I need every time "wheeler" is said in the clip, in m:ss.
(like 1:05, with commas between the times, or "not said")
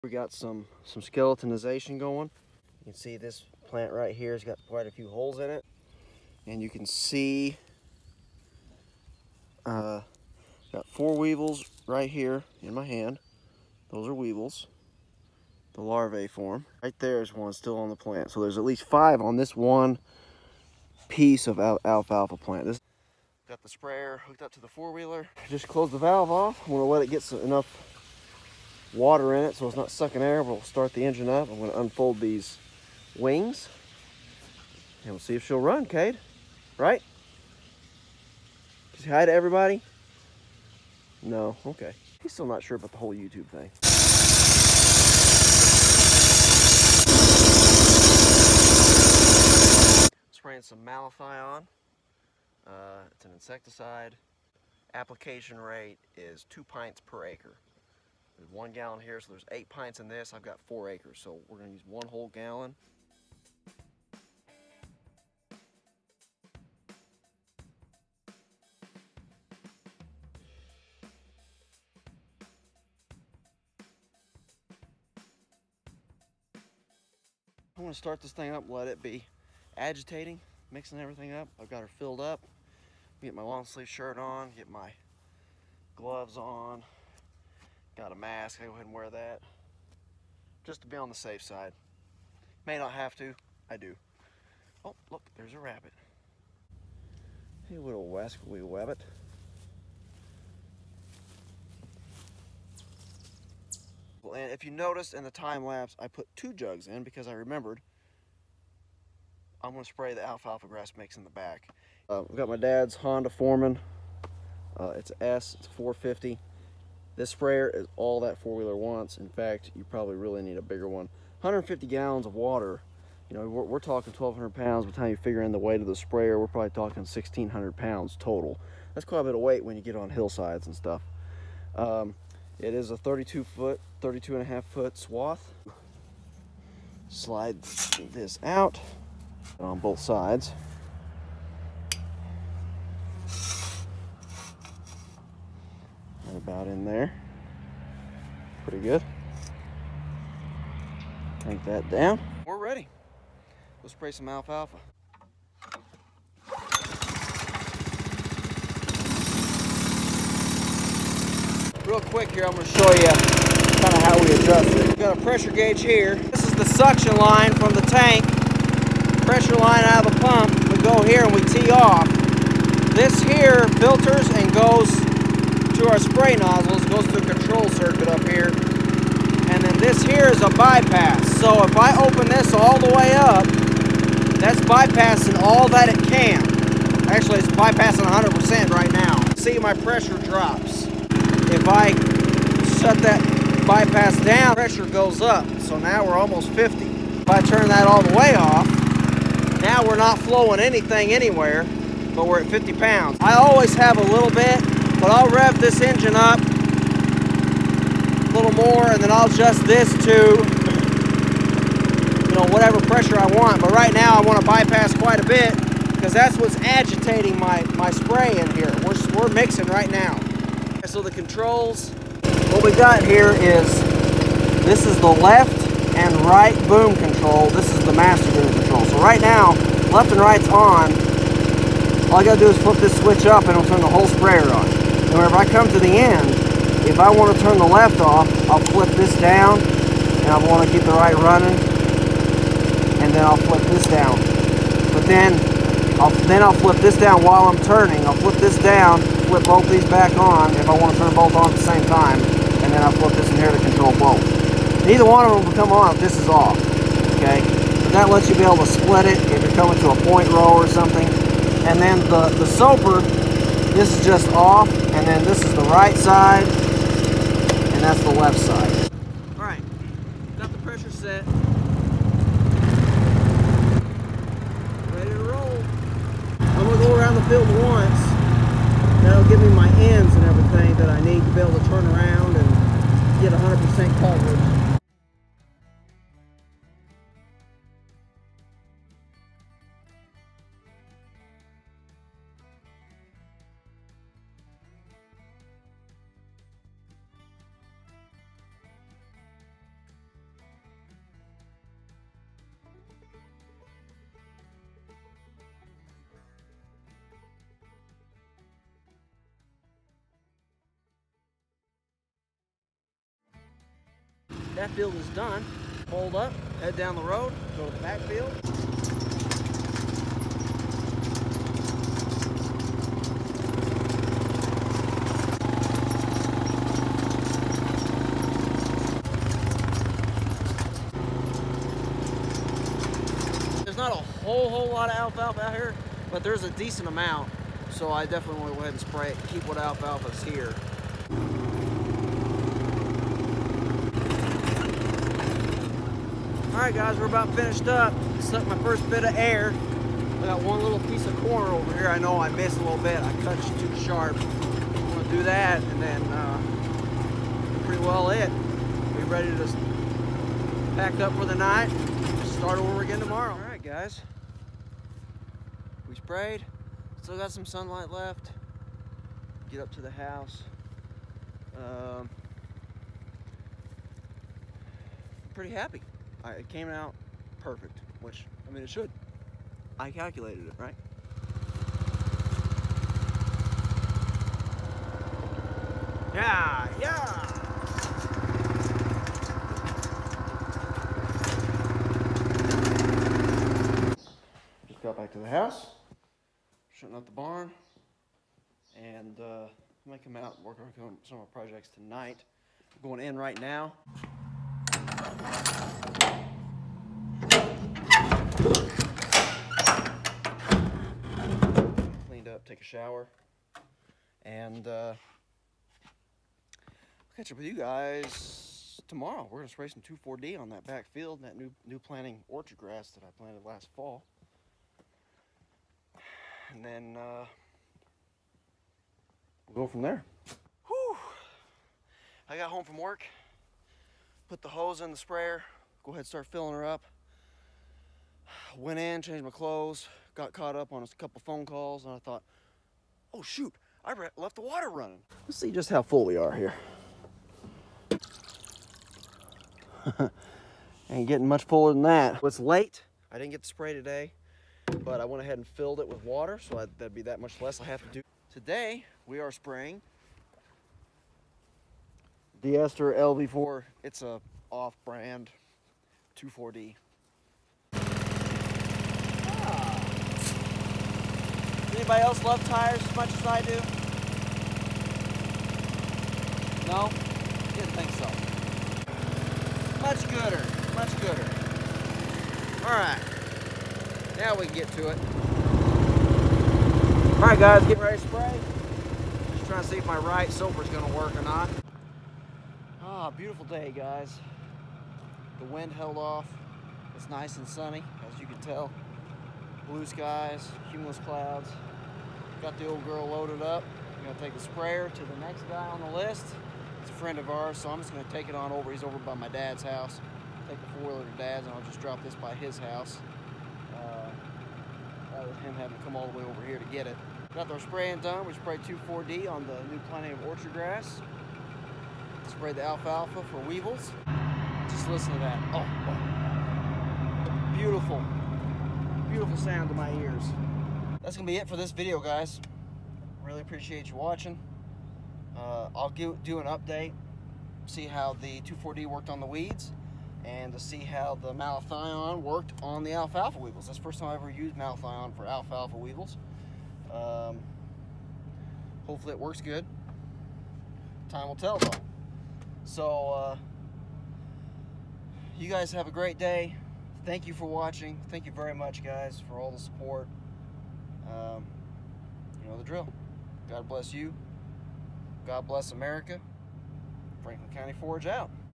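0:24, 1:58, 8:30.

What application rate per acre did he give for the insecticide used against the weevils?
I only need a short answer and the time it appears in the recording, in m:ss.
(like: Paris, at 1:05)
2 pints per acre, at 0:56.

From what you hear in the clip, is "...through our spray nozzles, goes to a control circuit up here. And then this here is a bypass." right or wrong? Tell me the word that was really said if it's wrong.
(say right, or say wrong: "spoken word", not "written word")
right.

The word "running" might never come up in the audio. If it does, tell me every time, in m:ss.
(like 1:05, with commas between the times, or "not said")
4:01, 7:24.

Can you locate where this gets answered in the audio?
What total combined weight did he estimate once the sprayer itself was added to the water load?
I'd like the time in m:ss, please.
2:07.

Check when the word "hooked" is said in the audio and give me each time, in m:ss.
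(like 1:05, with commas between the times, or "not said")
0:24.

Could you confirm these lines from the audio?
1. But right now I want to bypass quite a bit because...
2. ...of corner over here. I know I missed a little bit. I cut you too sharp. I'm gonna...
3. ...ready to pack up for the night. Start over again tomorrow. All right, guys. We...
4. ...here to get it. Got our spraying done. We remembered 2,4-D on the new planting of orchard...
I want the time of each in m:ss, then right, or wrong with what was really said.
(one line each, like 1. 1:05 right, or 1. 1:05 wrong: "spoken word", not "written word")
1. 3:33 right
2. 5:51 right
3. 5:59 right
4. 8:36 wrong: "sprayed", not "remembered".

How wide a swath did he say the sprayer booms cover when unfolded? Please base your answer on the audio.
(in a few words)
32 and a half feet.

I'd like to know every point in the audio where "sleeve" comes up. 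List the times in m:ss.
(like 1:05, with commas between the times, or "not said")
1:23.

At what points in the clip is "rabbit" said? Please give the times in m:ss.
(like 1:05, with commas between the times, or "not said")
1:35.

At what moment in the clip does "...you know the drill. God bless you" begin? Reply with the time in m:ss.
9:22.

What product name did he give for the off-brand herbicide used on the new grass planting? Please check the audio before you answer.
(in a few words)
Deester LV4.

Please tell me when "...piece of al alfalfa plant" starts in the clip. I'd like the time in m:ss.
0:21.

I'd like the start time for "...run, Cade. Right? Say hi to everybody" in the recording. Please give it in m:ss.
0:35.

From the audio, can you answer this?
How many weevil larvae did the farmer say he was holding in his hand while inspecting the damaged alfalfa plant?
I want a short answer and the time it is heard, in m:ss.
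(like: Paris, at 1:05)
4, at 0:10.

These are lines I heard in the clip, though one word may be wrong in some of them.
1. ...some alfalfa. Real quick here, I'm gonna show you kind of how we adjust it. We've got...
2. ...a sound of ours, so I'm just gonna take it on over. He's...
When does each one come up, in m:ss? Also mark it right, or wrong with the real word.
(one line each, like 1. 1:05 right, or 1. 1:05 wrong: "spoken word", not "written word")
1. 2:34 right
2. 8:26 wrong: "friend", not "sound".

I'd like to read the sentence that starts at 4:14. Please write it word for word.
Neither one of them will come on if this is off, okay?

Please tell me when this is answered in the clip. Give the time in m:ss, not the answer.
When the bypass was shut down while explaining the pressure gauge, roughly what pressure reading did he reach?
3:22.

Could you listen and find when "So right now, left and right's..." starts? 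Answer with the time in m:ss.
3:48.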